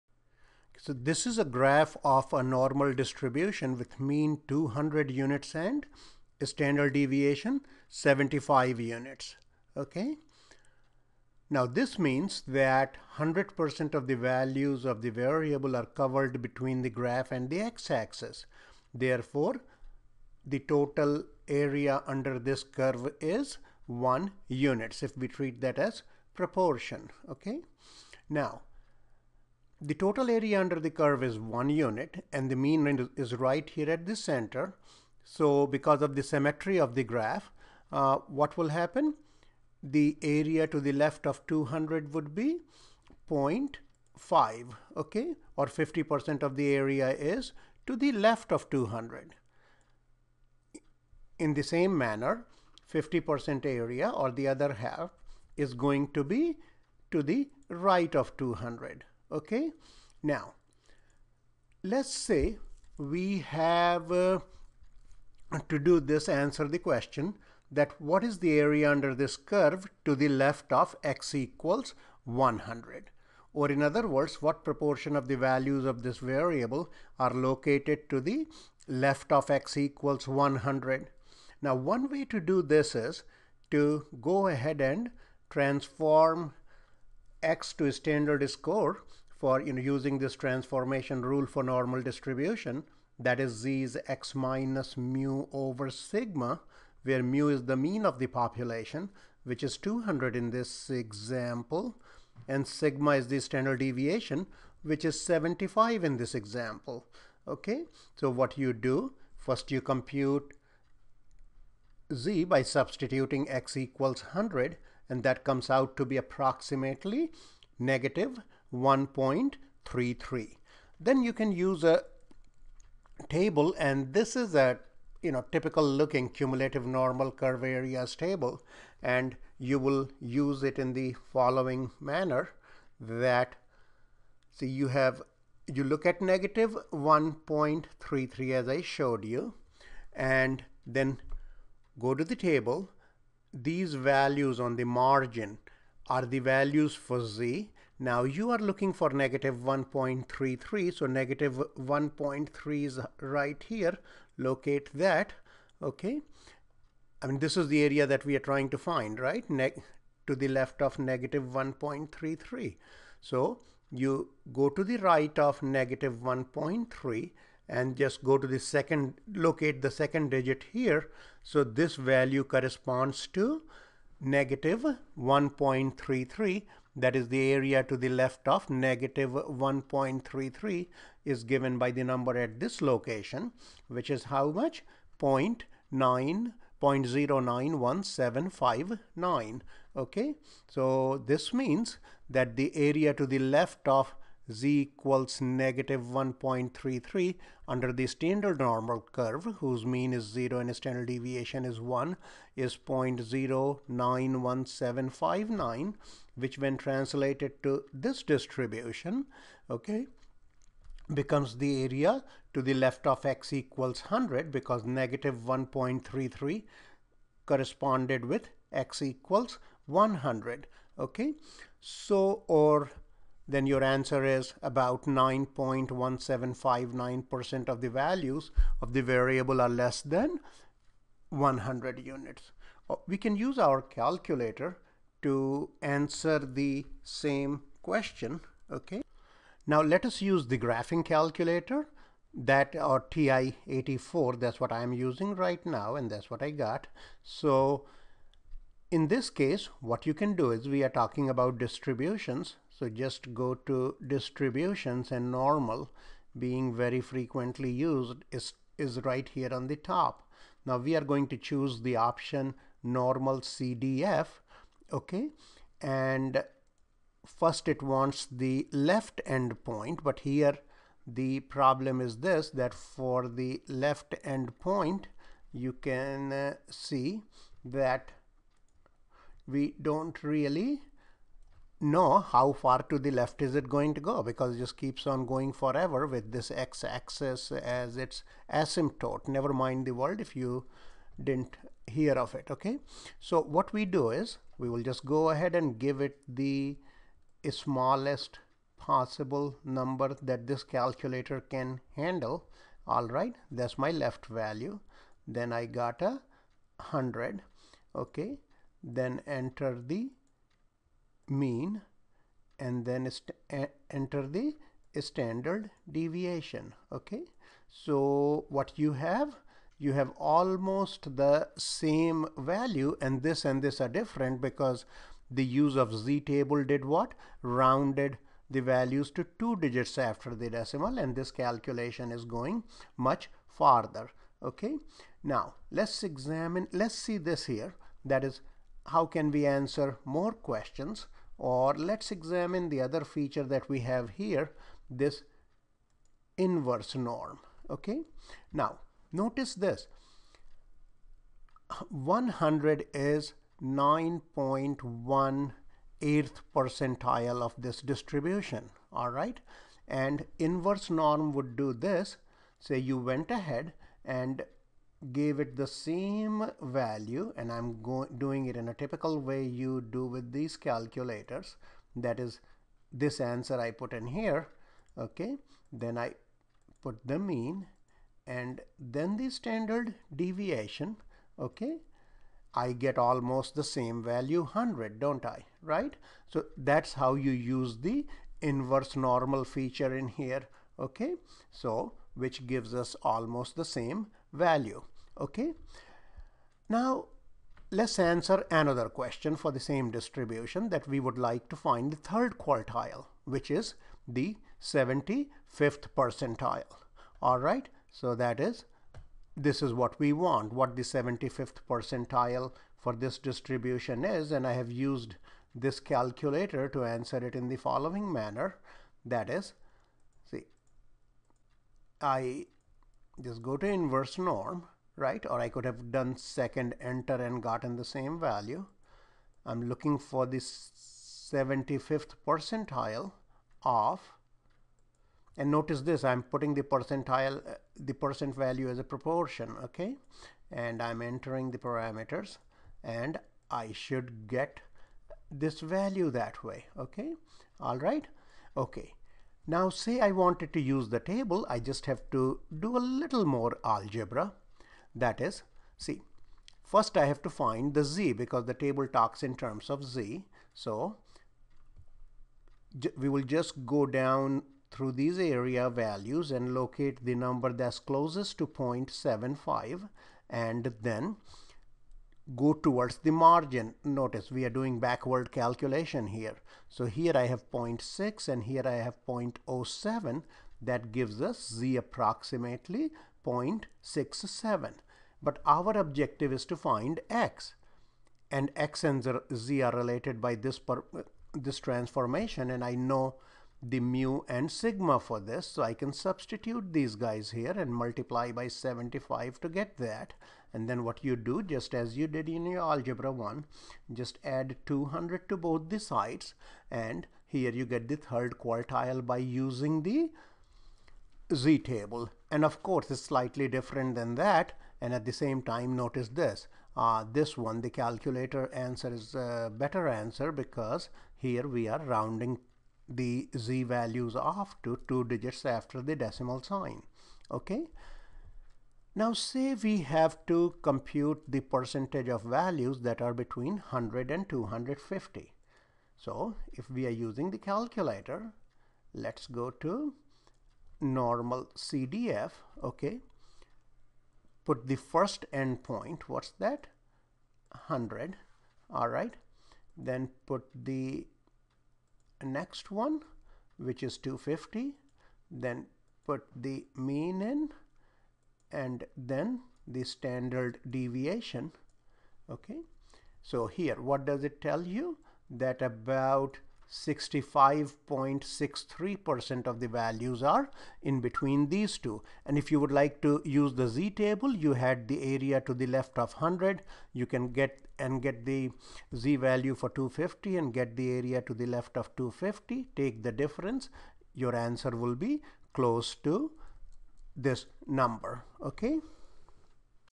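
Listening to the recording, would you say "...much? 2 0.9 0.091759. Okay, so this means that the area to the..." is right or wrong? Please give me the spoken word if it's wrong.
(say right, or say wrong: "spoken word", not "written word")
wrong: "0", not "2".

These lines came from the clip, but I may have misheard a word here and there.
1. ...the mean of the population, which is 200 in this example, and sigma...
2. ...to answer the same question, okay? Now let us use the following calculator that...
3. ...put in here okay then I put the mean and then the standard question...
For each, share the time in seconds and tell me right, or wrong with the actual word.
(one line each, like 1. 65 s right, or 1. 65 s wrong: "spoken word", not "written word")
1. 97 s right
2. 235 s wrong: "graphing", not "following"
3. 373 s wrong: "deviation", not "question".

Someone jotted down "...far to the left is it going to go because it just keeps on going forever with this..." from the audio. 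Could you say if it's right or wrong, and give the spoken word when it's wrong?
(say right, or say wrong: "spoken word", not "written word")
right.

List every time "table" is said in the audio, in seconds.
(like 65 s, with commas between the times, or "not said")
123 s, 128 s, 142 s, 326 s, 450 s, 458 s, 511 s, 573 s.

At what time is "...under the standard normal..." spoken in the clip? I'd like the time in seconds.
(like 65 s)
197 s.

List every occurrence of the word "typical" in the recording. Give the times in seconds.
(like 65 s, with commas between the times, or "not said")
125 s, 368 s.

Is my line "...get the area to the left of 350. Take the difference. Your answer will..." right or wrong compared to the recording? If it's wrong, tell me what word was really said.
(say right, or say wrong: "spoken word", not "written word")
wrong: "250", not "350".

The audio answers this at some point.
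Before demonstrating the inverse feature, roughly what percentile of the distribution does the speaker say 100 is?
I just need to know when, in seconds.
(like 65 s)
353 s.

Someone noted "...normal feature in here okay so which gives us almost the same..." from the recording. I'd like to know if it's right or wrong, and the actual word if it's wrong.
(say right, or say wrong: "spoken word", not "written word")
right.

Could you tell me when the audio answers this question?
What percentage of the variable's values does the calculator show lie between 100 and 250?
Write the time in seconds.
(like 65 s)
566 s.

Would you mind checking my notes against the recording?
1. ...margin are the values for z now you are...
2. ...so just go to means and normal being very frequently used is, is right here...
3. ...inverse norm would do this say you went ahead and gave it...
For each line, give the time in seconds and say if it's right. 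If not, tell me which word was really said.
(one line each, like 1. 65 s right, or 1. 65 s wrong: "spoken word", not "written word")
1. 144 s right
2. 252 s wrong: "distributions", not "means"
3. 360 s right.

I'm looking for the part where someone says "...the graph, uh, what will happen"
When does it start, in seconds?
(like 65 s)
36 s.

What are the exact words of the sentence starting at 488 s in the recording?
And x and z are related by this, per, this transformation.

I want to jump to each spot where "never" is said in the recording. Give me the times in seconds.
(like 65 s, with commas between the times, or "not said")
289 s.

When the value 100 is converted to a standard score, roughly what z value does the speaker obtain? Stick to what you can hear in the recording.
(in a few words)
-1.33.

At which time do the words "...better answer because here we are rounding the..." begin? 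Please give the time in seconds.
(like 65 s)
519 s.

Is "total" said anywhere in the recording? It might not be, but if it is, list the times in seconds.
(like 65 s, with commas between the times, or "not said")
20 s, 29 s.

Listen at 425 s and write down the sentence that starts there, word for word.
Or I could have done second enter and gotten the same value.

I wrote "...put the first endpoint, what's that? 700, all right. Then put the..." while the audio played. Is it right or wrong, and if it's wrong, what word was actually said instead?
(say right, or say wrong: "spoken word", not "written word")
wrong: "100", not "700".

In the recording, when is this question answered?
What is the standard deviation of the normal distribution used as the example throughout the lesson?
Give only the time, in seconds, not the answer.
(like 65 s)
6 s.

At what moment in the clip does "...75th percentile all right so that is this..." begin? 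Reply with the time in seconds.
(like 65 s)
404 s.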